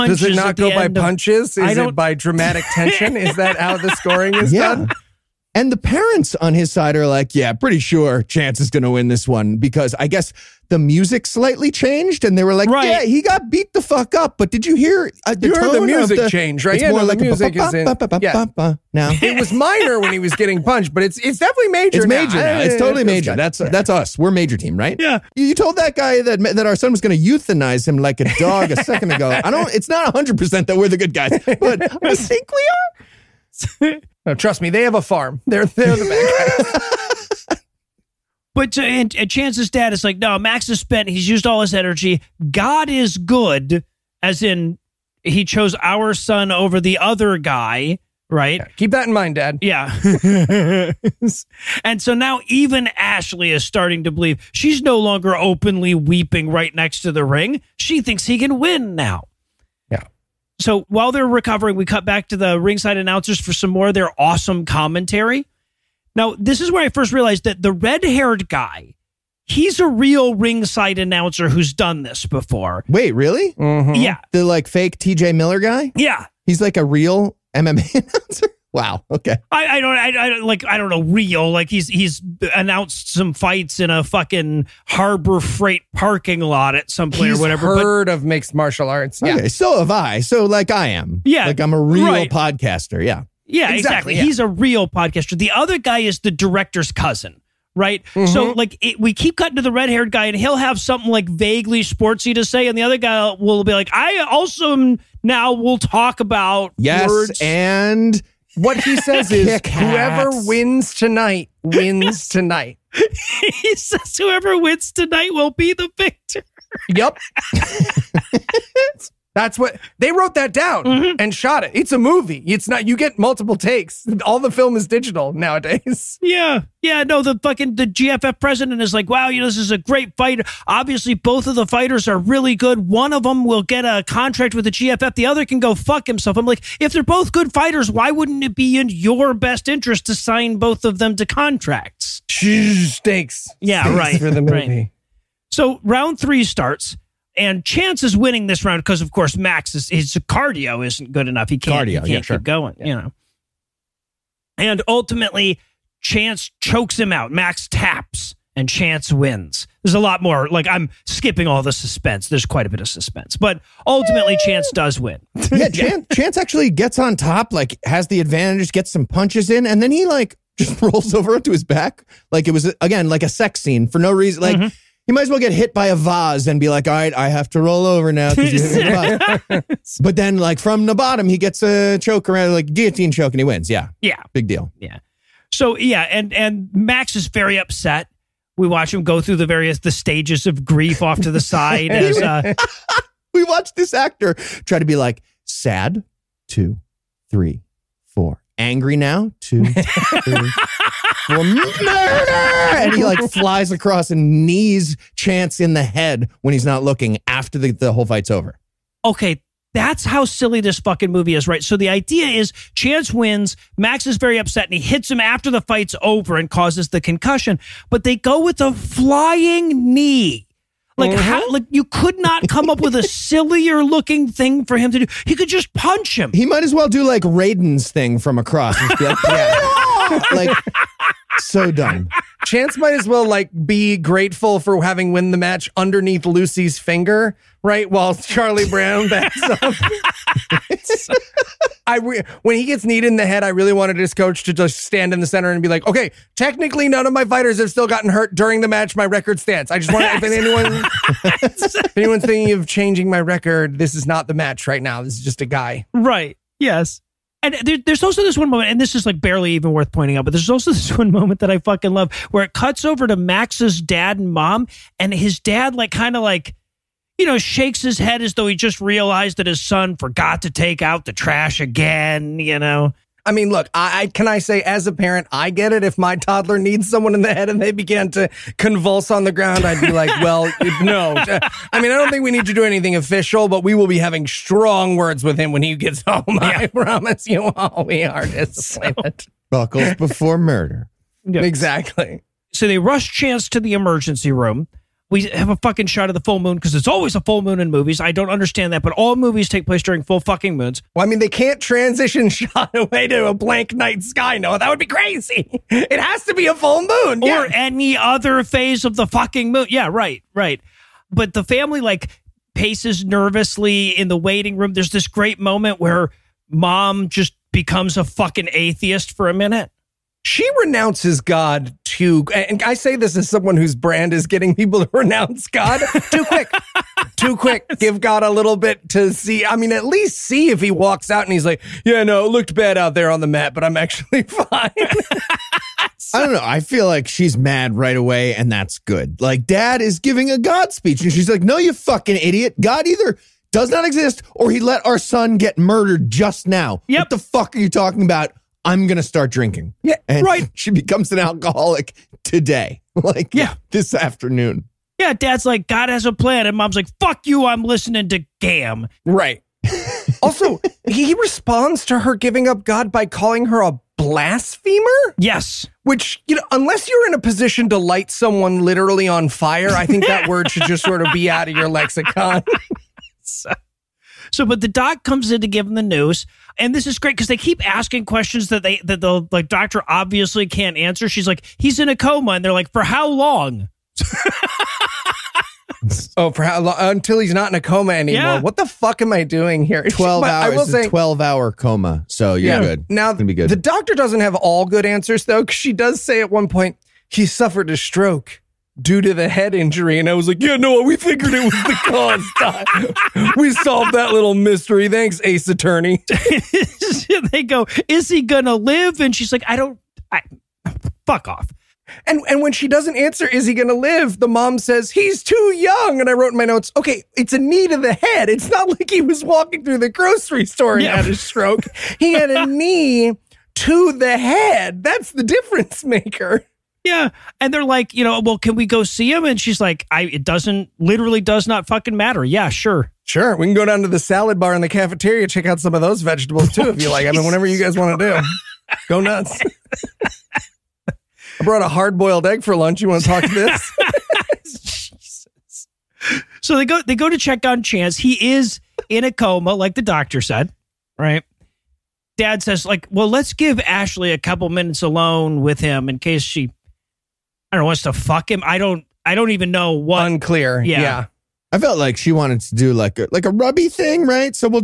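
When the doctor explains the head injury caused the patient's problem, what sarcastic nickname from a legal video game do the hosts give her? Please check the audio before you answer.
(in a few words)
Ace Attorney.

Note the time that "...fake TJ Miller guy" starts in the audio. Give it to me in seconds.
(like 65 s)
74 s.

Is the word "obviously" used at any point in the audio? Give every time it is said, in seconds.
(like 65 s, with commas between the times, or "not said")
130 s, 379 s.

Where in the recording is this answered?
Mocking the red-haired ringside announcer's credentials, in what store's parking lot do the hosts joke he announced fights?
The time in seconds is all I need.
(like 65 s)
84 s.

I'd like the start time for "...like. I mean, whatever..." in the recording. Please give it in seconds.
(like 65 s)
436 s.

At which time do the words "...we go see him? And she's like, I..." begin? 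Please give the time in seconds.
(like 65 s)
428 s.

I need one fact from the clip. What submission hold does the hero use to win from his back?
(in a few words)
Guillotine choke.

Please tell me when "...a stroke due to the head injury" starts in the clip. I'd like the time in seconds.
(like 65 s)
397 s.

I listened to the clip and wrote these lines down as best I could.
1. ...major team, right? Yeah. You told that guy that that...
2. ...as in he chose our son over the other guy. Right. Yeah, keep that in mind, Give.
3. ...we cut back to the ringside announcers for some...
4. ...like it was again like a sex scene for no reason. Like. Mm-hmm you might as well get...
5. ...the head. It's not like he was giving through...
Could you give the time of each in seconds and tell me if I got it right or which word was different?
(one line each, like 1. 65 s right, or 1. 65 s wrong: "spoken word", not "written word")
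1. 24 s right
2. 44 s wrong: "Dad", not "Give"
3. 61 s right
4. 172 s right
5. 417 s wrong: "walking", not "giving".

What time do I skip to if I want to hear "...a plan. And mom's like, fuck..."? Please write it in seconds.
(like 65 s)
356 s.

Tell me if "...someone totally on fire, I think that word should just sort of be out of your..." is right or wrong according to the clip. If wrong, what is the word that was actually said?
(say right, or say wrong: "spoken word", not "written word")
wrong: "literally", not "totally".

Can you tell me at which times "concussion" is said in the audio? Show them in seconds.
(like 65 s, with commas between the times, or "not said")
217 s.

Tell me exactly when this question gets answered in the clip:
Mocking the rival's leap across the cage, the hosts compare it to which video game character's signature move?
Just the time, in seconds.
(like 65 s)
227 s.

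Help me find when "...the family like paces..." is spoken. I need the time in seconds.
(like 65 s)
311 s.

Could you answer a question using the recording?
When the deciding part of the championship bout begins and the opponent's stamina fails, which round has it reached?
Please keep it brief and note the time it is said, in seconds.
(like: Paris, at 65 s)
3, at 145 s.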